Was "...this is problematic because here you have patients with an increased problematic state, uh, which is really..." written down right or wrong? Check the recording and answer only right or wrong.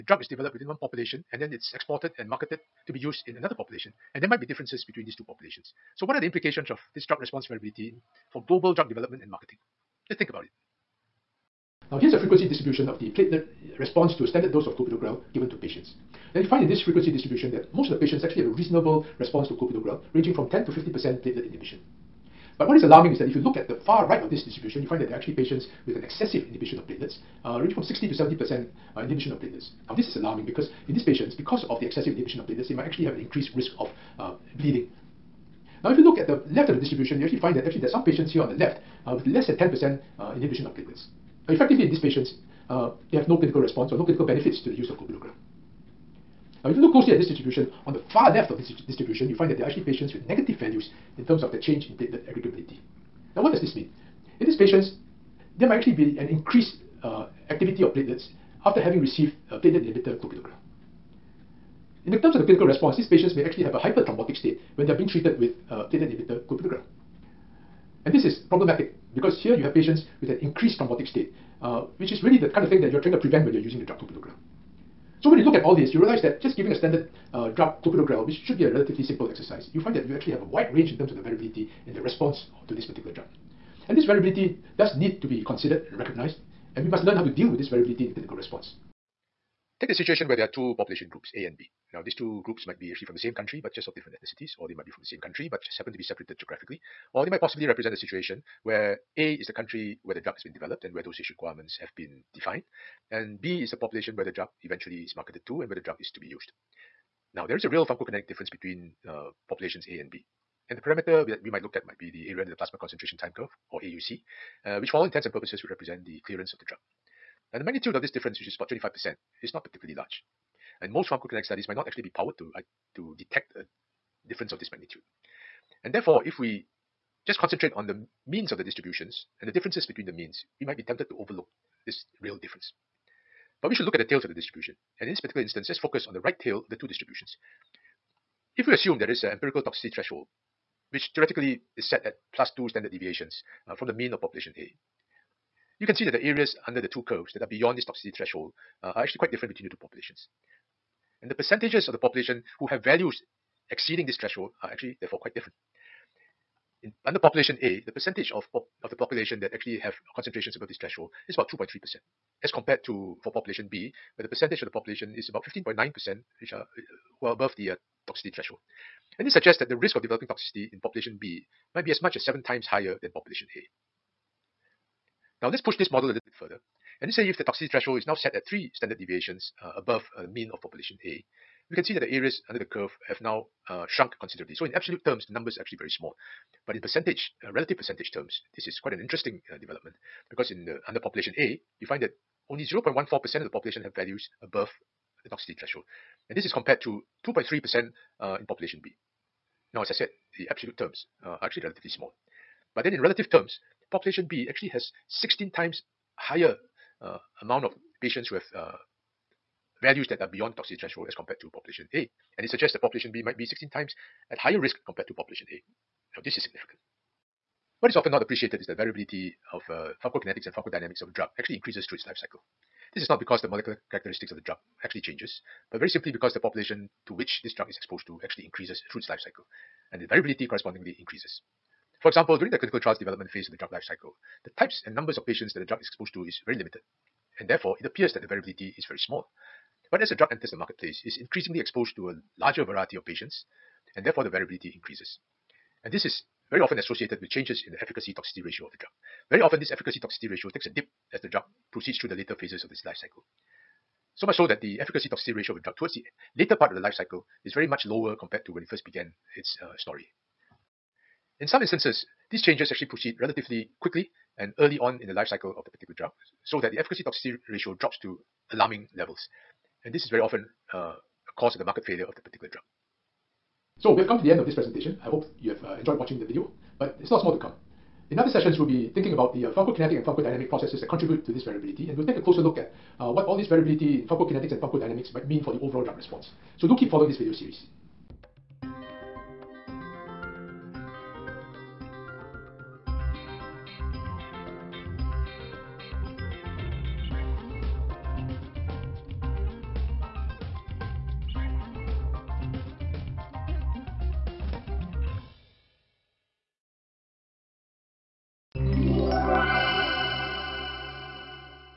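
wrong.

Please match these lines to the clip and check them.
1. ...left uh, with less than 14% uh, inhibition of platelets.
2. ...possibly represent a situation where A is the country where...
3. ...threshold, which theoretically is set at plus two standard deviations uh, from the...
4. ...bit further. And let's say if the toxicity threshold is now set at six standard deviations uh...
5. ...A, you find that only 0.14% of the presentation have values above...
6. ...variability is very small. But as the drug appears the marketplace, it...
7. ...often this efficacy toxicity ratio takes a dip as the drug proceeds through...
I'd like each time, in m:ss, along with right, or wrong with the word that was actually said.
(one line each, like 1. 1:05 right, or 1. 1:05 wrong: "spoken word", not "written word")
1. 0:38 wrong: "10", not "14"
2. 1:37 right
3. 2:19 right
4. 2:56 wrong: "three", not "six"
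5. 3:11 wrong: "population", not "presentation"
6. 3:58 wrong: "enters", not "appears"
7. 4:09 right.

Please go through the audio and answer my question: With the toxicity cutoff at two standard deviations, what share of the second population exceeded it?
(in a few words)
15.9%.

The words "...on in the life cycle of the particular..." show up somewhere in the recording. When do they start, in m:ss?
4:24.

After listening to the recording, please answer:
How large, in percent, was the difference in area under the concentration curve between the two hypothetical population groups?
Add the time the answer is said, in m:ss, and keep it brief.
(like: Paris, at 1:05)
25%, at 1:58.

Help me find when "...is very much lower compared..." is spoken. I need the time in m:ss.
4:17.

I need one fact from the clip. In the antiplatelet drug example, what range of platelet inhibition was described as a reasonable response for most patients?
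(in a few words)
10 to 50%.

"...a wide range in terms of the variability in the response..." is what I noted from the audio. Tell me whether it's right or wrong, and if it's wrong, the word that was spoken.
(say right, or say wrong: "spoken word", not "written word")
right.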